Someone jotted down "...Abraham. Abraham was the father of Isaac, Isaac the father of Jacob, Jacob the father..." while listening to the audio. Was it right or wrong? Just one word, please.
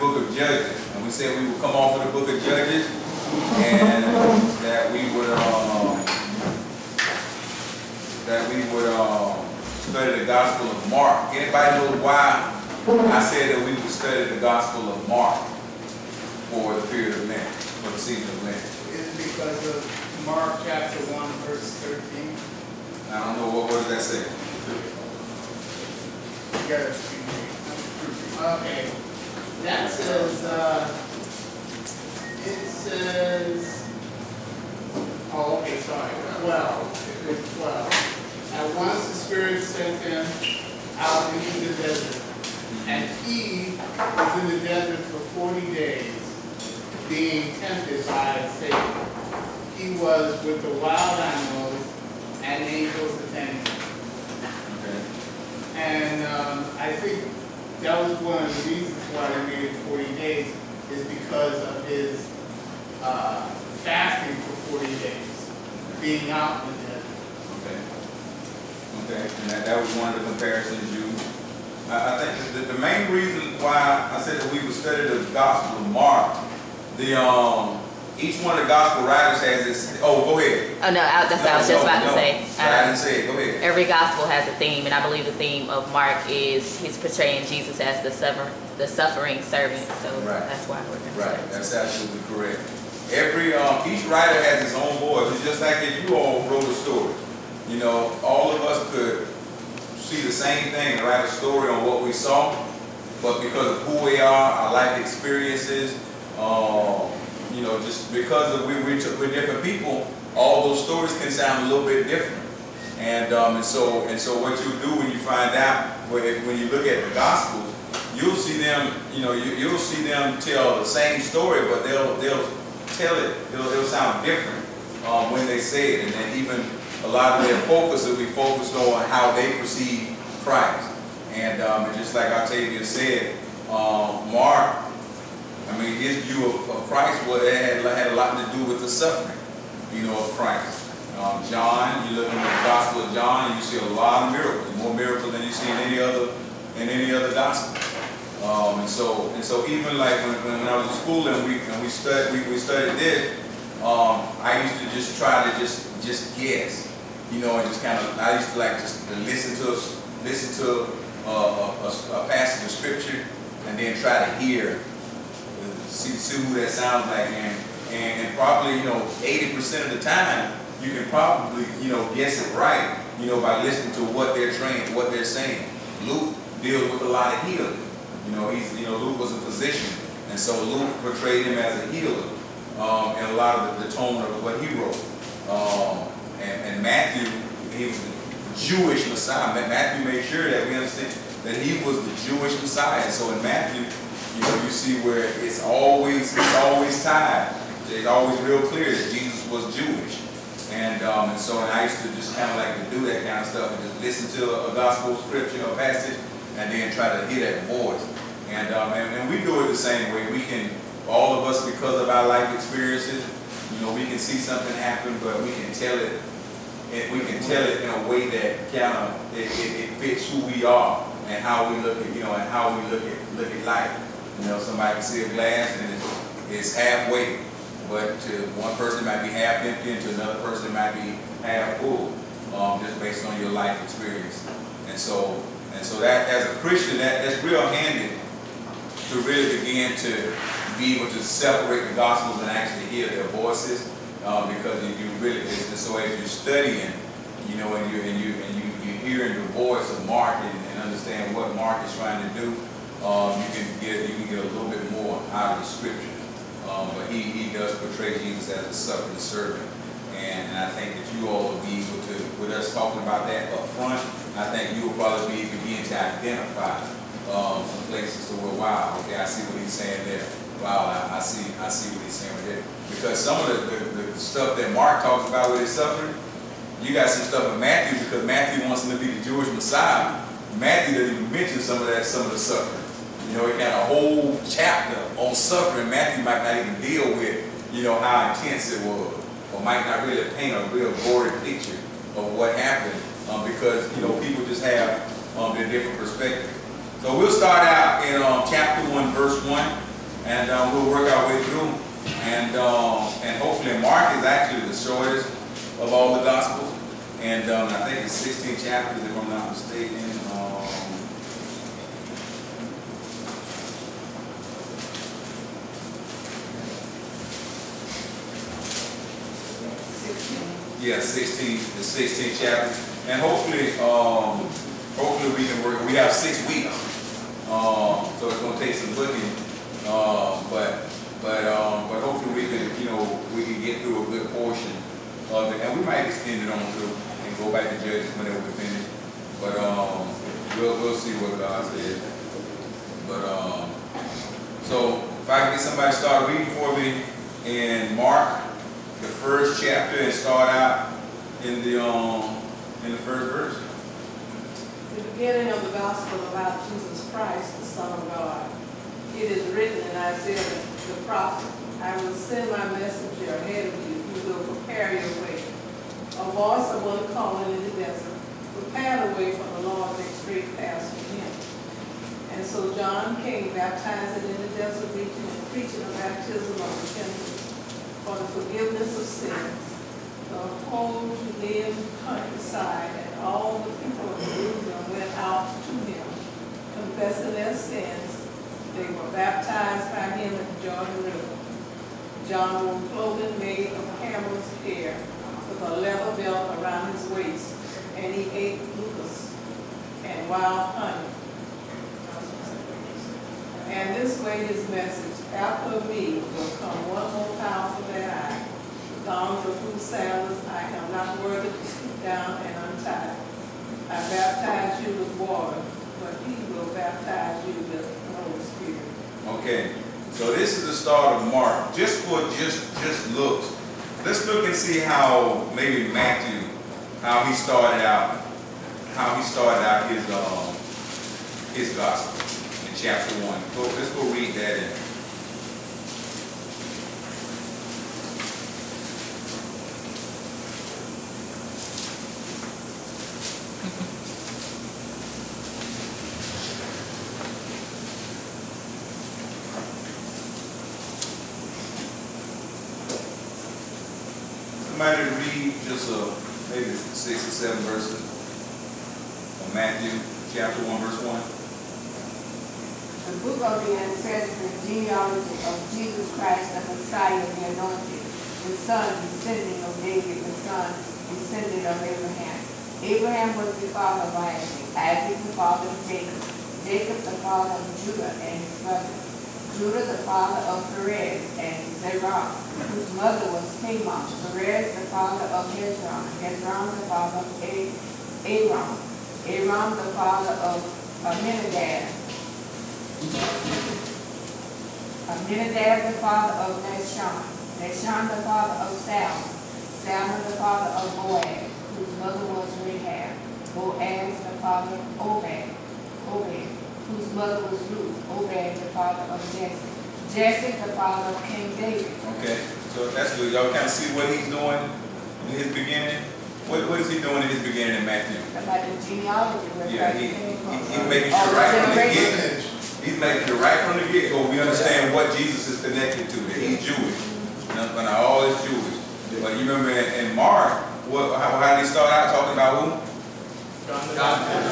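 right.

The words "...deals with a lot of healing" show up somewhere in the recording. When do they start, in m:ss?
2:56.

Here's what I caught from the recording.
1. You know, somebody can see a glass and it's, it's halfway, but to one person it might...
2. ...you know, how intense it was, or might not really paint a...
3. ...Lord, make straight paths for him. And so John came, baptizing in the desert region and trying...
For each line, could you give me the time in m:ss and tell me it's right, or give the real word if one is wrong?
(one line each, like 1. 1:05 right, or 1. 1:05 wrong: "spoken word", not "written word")
1. 3:44 right
2. 4:47 right
3. 6:09 wrong: "preaching", not "trying".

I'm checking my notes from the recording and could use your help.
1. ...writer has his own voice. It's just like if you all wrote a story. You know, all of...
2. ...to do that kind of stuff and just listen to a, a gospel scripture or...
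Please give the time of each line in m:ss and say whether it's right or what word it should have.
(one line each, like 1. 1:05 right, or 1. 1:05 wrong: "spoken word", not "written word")
1. 1:34 right
2. 3:22 right.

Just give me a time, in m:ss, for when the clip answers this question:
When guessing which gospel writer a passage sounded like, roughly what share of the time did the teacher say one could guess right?
2:49.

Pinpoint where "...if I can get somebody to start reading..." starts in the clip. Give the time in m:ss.
5:45.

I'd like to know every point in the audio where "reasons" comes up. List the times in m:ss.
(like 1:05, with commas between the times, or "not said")
0:58, 1:13.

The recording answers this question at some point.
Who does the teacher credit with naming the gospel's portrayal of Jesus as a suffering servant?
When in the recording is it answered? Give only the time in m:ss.
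2:12.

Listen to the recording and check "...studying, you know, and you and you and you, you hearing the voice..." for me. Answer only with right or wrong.
right.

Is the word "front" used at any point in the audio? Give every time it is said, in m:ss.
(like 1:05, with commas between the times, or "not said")
4:23.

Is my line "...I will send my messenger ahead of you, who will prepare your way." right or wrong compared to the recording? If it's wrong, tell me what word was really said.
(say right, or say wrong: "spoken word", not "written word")
right.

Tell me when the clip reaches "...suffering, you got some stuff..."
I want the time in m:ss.
4:35.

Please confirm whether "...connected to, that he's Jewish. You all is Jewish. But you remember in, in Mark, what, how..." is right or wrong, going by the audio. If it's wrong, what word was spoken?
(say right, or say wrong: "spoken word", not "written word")
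right.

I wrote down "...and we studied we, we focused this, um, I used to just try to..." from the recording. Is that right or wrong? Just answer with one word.
wrong.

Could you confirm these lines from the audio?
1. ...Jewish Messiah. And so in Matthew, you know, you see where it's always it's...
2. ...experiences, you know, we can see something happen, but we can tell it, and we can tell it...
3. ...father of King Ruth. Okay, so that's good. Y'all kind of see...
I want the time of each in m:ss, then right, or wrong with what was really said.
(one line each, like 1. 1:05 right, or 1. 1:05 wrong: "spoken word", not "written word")
1. 3:12 right
2. 3:32 right
3. 8:30 wrong: "David", not "Ruth".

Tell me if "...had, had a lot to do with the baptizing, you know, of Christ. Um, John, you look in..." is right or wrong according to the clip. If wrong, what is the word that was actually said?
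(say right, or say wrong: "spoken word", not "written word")
wrong: "suffering", not "baptizing".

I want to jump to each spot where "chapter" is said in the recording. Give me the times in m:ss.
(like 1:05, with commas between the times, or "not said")
0:20, 4:44, 4:58, 5:08, 5:22, 5:49, 7:12, 7:40.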